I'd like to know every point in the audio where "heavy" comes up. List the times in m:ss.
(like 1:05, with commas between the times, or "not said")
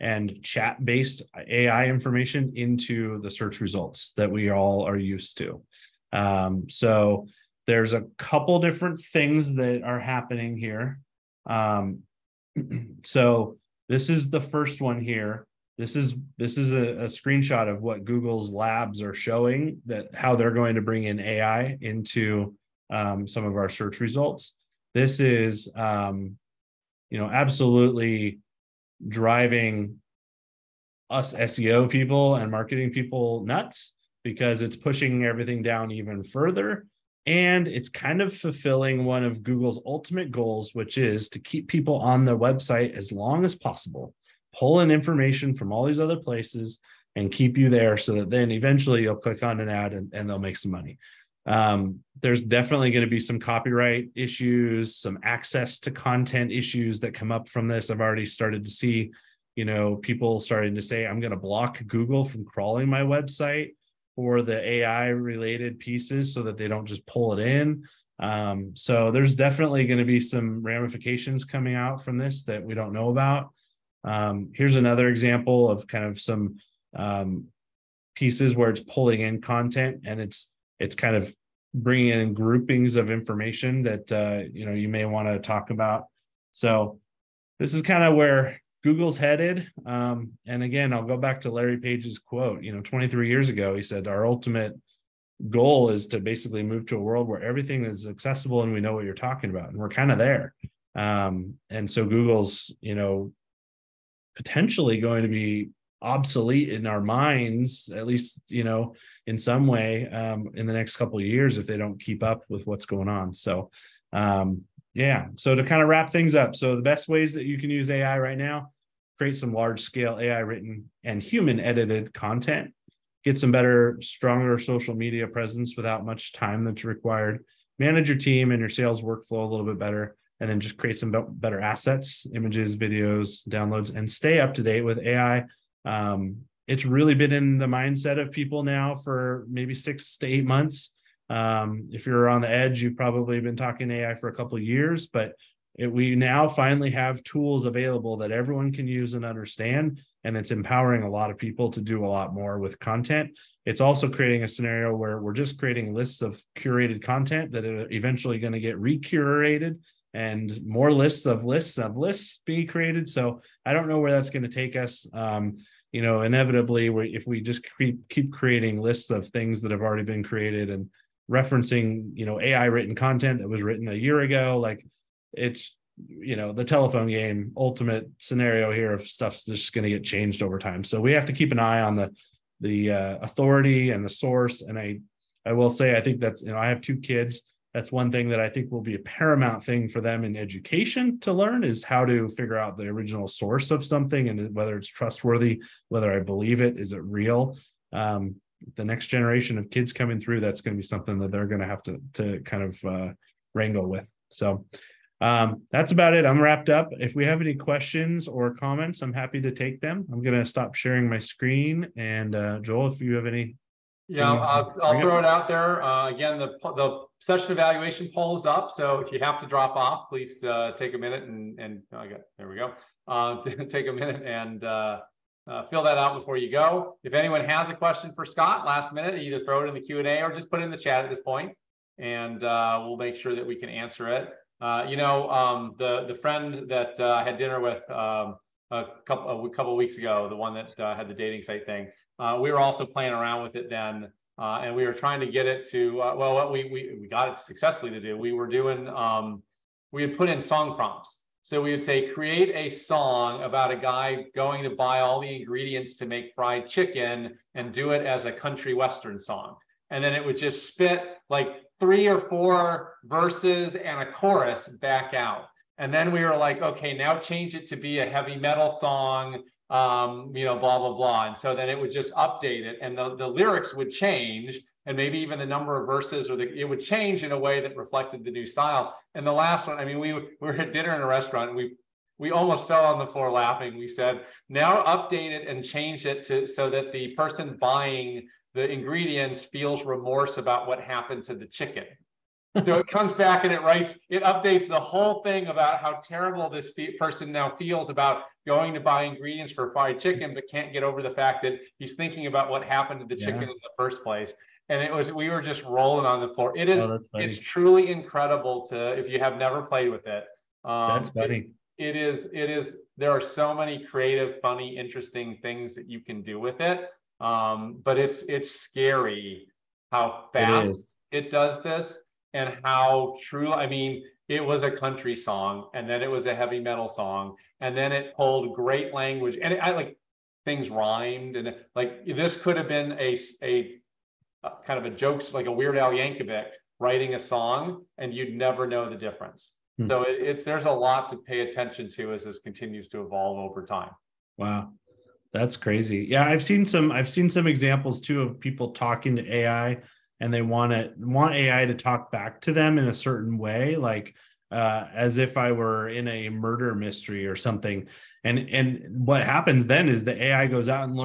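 4:28, 5:26.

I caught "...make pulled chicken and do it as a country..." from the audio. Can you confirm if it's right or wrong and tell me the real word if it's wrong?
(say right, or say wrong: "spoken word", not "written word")
wrong: "fried", not "pulled".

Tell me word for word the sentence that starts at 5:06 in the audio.
It is, oh, it's truly incredible to, if you have never played with it.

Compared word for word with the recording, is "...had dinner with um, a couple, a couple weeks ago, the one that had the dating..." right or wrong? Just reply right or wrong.
right.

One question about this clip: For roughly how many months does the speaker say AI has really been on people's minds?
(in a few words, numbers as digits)
six to eight months.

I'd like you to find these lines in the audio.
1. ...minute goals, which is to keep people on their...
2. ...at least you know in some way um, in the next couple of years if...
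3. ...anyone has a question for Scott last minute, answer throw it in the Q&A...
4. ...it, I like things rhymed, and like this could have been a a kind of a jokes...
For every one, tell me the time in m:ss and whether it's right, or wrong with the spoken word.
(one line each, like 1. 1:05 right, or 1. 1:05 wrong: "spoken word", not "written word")
1. 0:39 wrong: "ultimate", not "minute"
2. 1:47 right
3. 3:47 wrong: "either", not "answer"
4. 5:29 right.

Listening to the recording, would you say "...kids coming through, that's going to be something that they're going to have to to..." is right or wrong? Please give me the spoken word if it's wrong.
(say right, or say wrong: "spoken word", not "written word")
right.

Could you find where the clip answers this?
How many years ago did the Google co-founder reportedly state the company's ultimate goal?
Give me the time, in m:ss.
1:32.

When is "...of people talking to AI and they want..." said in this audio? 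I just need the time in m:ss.
5:48.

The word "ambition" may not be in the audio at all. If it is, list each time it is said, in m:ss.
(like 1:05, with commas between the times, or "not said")
not said.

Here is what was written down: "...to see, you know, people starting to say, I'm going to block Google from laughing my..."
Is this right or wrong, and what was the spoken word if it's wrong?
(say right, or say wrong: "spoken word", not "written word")
wrong: "crawling", not "laughing".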